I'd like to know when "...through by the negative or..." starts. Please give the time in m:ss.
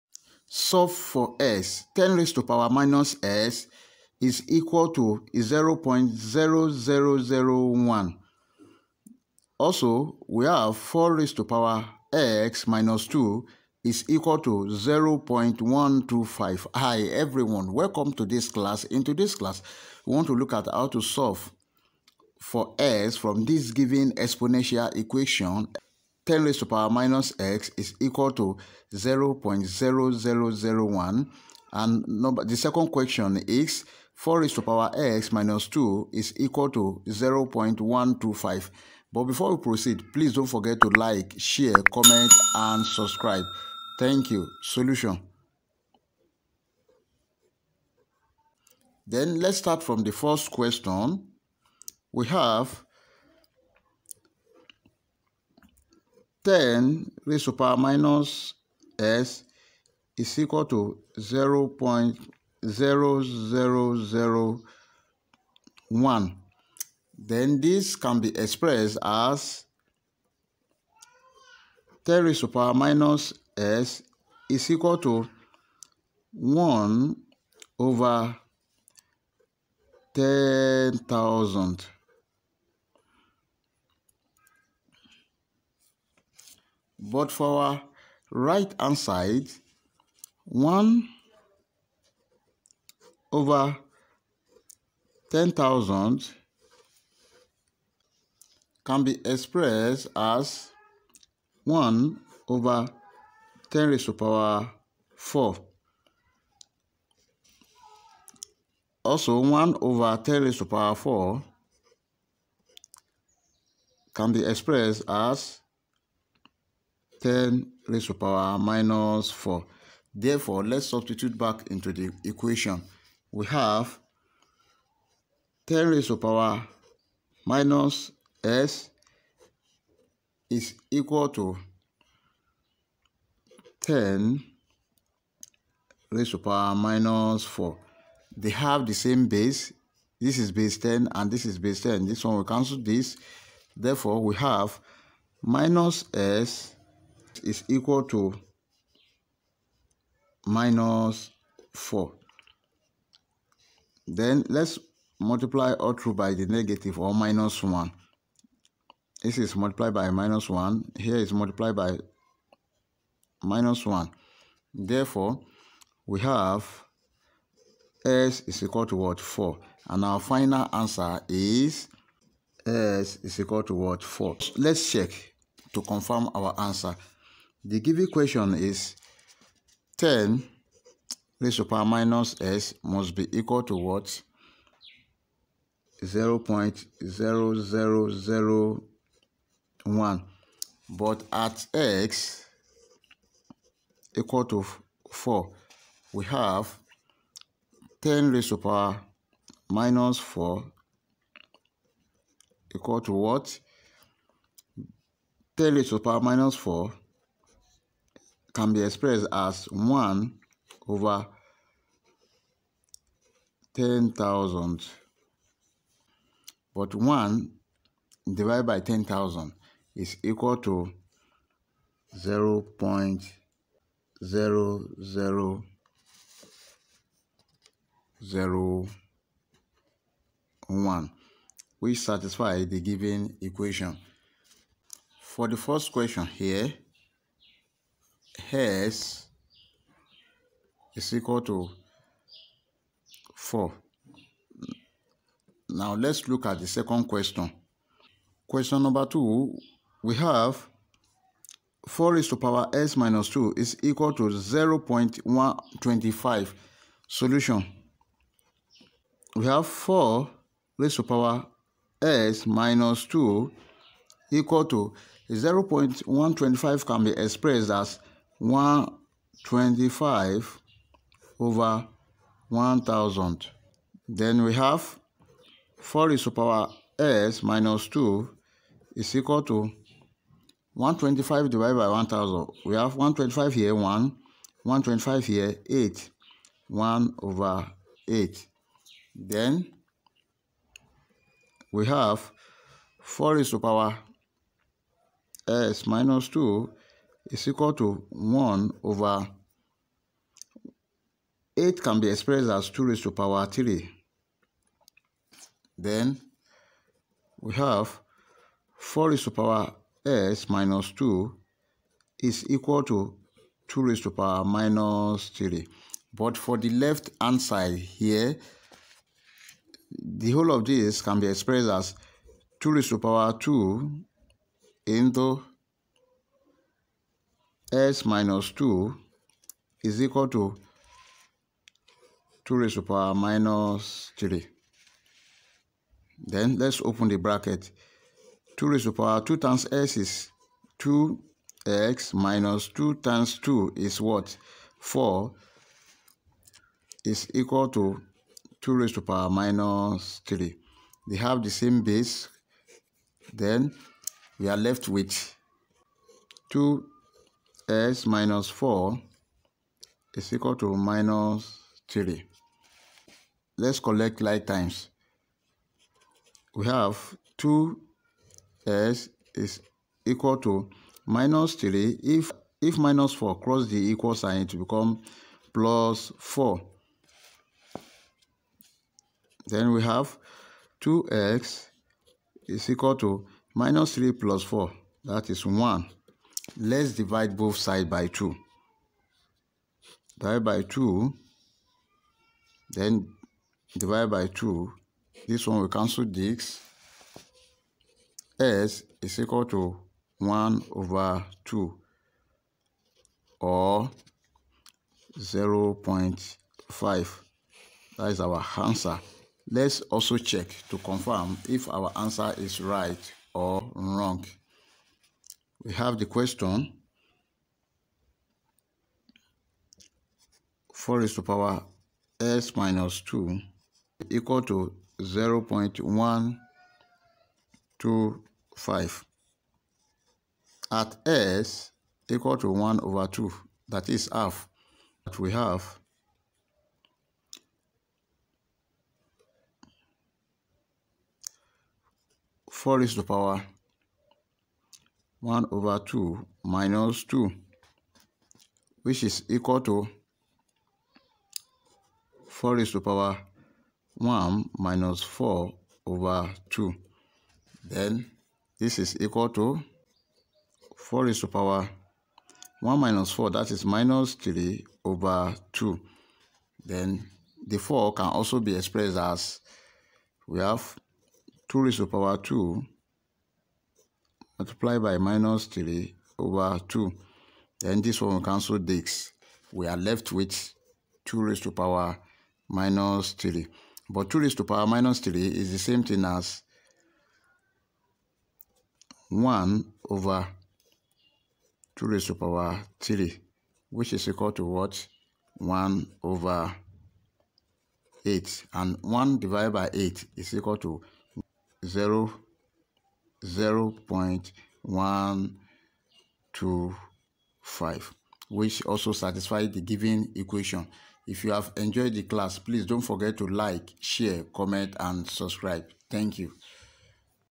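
2:35.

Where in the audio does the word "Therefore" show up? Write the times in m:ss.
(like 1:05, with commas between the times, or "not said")
2:00, 2:23, 2:44.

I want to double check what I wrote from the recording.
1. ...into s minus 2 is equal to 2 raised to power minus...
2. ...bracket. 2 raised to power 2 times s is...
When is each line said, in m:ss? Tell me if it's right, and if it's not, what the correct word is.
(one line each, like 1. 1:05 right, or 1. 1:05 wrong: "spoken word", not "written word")
1. 5:24 right
2. 5:37 right.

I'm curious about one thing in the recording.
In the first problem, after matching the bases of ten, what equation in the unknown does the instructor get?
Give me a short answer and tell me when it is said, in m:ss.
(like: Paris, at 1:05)
-s = -4, at 2:25.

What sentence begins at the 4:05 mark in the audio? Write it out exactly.
Now let's look at the second question.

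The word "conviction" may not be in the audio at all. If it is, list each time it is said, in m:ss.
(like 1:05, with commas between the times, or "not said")
not said.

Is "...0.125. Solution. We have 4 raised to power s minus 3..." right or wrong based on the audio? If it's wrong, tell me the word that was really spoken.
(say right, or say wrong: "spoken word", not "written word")
wrong: "2", not "3".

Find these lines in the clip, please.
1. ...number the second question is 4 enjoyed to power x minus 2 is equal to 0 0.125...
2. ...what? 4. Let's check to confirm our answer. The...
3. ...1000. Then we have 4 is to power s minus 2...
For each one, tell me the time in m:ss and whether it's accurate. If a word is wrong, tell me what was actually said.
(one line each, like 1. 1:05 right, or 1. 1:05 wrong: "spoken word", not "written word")
1. 0:32 wrong: "raised", not "enjoyed"
2. 2:53 right
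3. 4:32 right.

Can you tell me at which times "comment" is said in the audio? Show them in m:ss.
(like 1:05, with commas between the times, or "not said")
0:41, 8:34.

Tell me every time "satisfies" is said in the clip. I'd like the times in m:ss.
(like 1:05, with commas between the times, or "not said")
3:51, 8:28.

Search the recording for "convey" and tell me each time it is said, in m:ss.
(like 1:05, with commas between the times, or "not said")
not said.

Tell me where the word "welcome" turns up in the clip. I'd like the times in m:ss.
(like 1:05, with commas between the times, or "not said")
0:17.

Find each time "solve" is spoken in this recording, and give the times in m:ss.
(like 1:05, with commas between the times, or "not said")
0:00, 0:20.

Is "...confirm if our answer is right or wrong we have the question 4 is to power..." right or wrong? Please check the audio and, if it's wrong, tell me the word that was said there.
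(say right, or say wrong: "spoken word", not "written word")
right.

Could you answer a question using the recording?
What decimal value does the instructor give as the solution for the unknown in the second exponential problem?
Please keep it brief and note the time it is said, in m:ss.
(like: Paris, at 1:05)
0.5, at 6:45.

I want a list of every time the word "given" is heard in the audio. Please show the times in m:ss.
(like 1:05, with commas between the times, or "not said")
0:23, 2:57, 3:52, 8:29.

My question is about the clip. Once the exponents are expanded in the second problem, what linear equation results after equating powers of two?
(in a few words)
2x - 4 = -3.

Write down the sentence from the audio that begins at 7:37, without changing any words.
Then this is equal to 4 raised to power 1 minus 4, that is minus 3 over 2.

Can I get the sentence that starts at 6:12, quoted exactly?
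If, if minus 4 cross the equal sign, it become plus 4.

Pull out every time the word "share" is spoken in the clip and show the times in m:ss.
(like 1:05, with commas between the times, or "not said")
0:41, 8:33.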